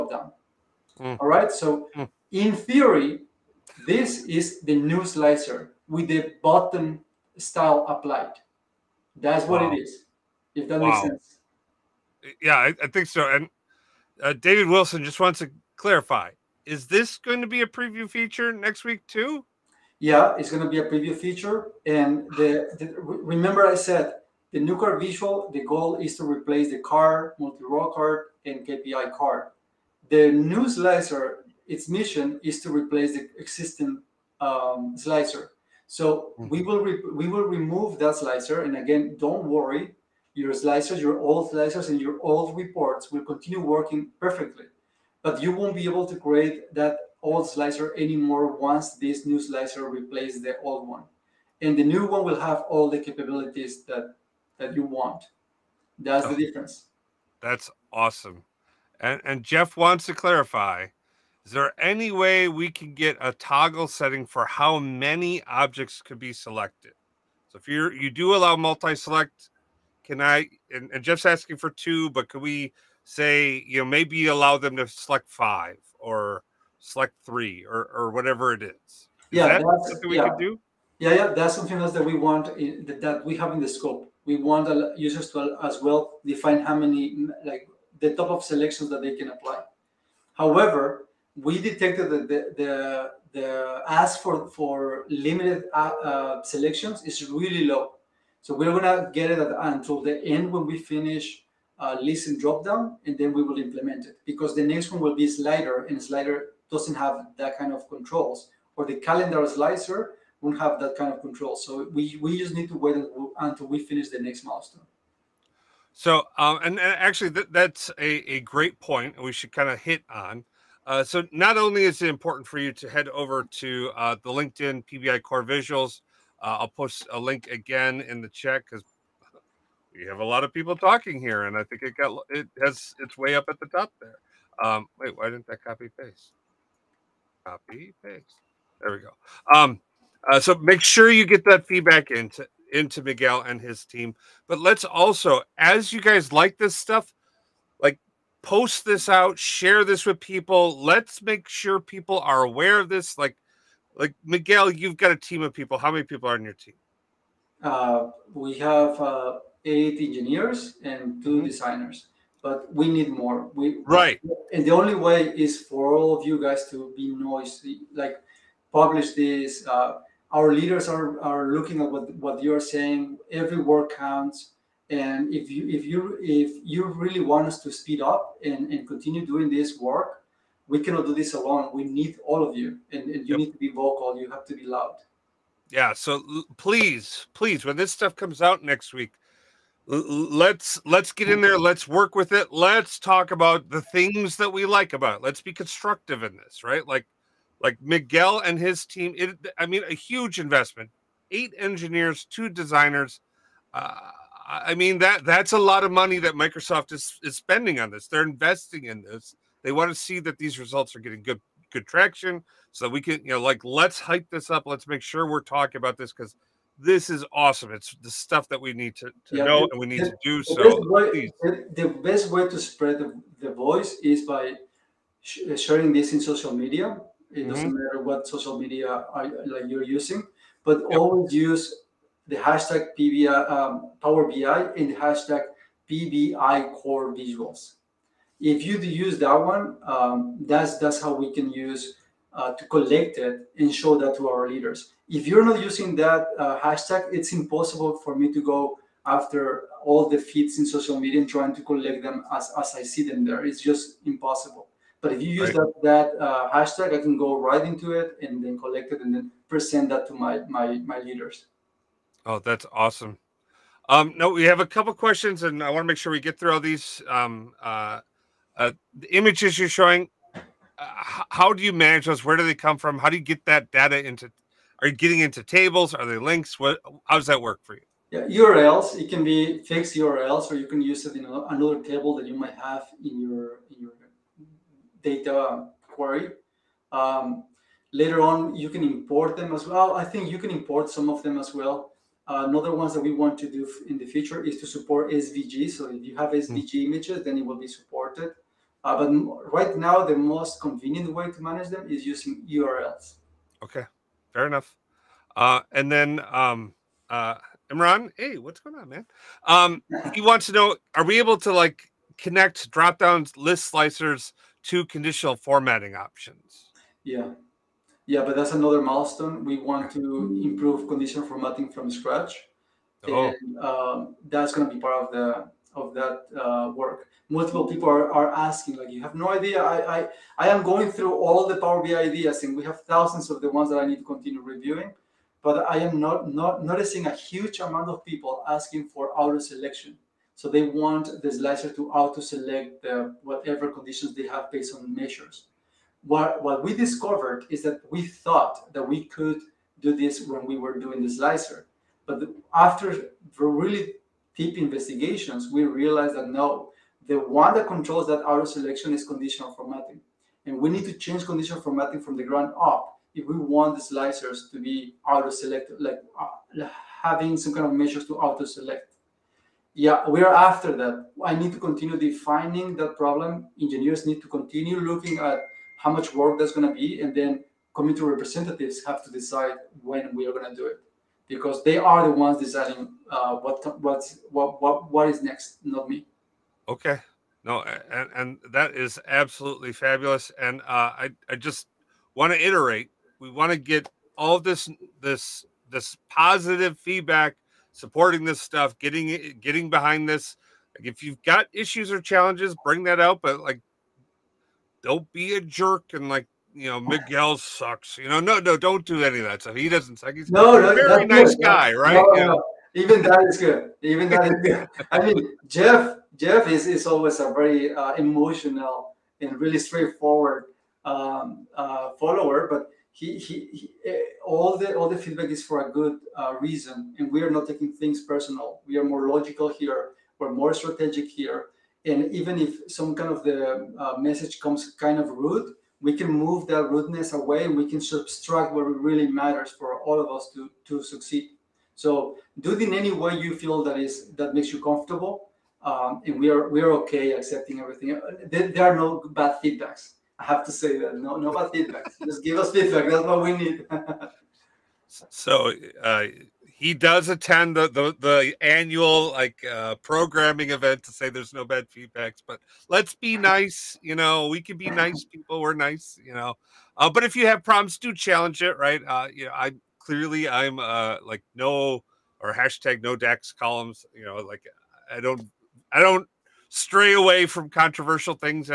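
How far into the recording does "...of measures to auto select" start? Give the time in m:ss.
6:07.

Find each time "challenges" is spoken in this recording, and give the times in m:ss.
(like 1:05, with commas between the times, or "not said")
6:42, 7:47.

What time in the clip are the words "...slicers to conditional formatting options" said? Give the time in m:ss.
5:13.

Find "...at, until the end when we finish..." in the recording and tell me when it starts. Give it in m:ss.
1:39.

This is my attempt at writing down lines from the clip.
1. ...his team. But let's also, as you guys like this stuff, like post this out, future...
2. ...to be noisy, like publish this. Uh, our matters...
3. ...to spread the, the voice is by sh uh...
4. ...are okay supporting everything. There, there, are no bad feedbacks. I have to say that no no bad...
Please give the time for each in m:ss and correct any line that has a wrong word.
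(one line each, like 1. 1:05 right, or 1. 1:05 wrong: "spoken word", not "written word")
1. 2:23 wrong: "share", not "future"
2. 2:46 wrong: "leaders", not "matters"
3. 3:42 right
4. 7:26 wrong: "accepting", not "supporting".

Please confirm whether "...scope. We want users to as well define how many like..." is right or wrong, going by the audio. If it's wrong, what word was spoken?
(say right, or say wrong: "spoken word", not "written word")
right.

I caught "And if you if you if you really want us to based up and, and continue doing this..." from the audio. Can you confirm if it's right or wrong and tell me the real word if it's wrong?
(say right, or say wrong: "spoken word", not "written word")
wrong: "speed", not "based".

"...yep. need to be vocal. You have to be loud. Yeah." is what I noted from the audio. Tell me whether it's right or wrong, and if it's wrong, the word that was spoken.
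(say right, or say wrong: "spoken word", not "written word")
right.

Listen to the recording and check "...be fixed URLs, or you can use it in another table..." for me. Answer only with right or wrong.
right.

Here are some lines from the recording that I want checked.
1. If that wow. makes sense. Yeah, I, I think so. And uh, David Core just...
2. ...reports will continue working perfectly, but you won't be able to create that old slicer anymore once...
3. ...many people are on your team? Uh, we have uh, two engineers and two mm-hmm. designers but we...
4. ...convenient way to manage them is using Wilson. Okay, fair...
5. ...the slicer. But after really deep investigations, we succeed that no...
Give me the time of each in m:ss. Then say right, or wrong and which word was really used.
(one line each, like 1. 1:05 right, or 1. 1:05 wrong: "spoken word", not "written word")
1. 0:10 wrong: "Wilson", not "Core"
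2. 0:42 right
3. 2:35 wrong: "eight", not "two"
4. 5:00 wrong: "URLs", not "Wilson"
5. 5:51 wrong: "realized", not "succeed".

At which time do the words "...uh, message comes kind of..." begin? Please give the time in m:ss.
7:13.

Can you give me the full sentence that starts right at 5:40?
So they want the slicer to auto select the, whatever conditions they have based on measures.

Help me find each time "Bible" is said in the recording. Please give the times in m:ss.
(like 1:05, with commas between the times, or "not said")
not said.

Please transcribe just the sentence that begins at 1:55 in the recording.
So, um, and, and, actually, th that's a, a great point we should kind of hit on.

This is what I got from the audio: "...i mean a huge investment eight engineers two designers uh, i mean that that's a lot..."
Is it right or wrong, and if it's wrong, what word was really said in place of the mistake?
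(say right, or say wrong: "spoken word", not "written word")
right.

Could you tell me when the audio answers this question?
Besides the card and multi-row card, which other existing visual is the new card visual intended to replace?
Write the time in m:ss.
0:28.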